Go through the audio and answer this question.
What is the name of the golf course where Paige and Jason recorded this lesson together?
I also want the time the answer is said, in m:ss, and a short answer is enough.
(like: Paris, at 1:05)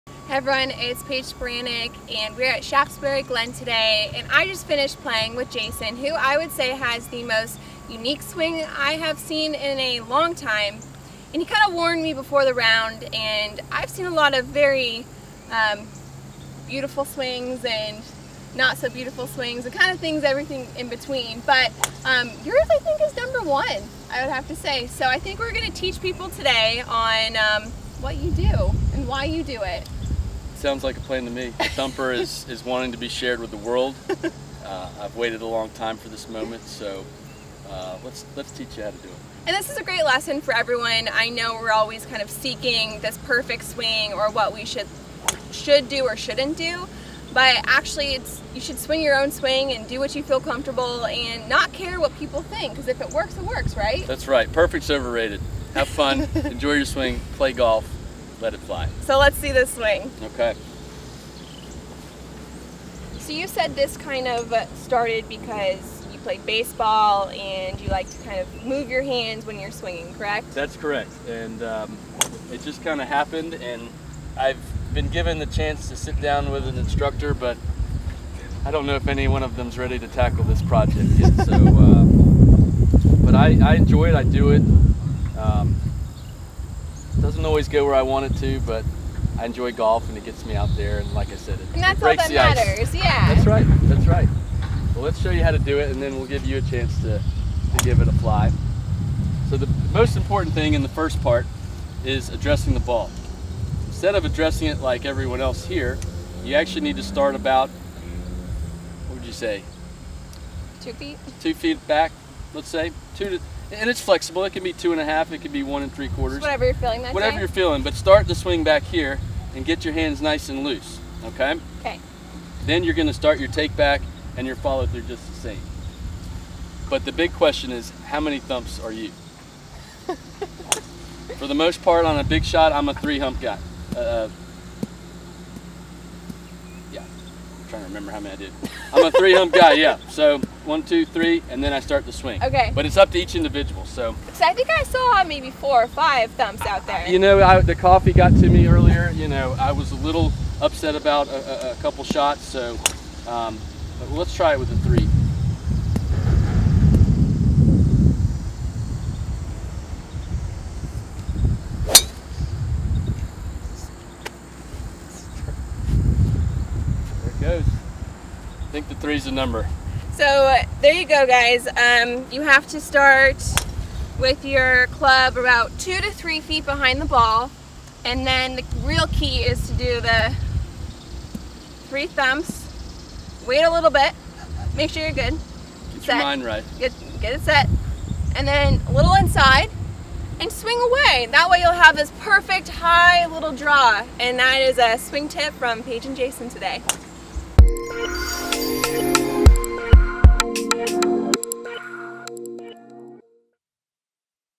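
Shaftesbury Glen, at 0:02.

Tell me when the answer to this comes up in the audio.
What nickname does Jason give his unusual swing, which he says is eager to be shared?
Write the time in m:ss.
0:31.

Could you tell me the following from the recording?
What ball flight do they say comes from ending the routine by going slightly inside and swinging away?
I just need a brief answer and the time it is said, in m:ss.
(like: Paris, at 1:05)
high little draw, at 3:12.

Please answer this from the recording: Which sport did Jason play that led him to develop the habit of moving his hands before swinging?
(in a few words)
baseball.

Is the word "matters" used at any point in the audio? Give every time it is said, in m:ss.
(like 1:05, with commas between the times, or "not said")
1:32.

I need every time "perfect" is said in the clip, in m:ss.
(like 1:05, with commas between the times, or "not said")
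0:43, 0:54, 3:12.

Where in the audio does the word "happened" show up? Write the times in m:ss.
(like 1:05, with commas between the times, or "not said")
1:13.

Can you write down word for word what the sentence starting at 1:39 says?
So the most important thing in the first part is addressing the ball.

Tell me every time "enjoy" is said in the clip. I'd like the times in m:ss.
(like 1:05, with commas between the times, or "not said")
0:56, 1:23, 1:29.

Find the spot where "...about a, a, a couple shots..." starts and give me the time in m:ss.
2:30.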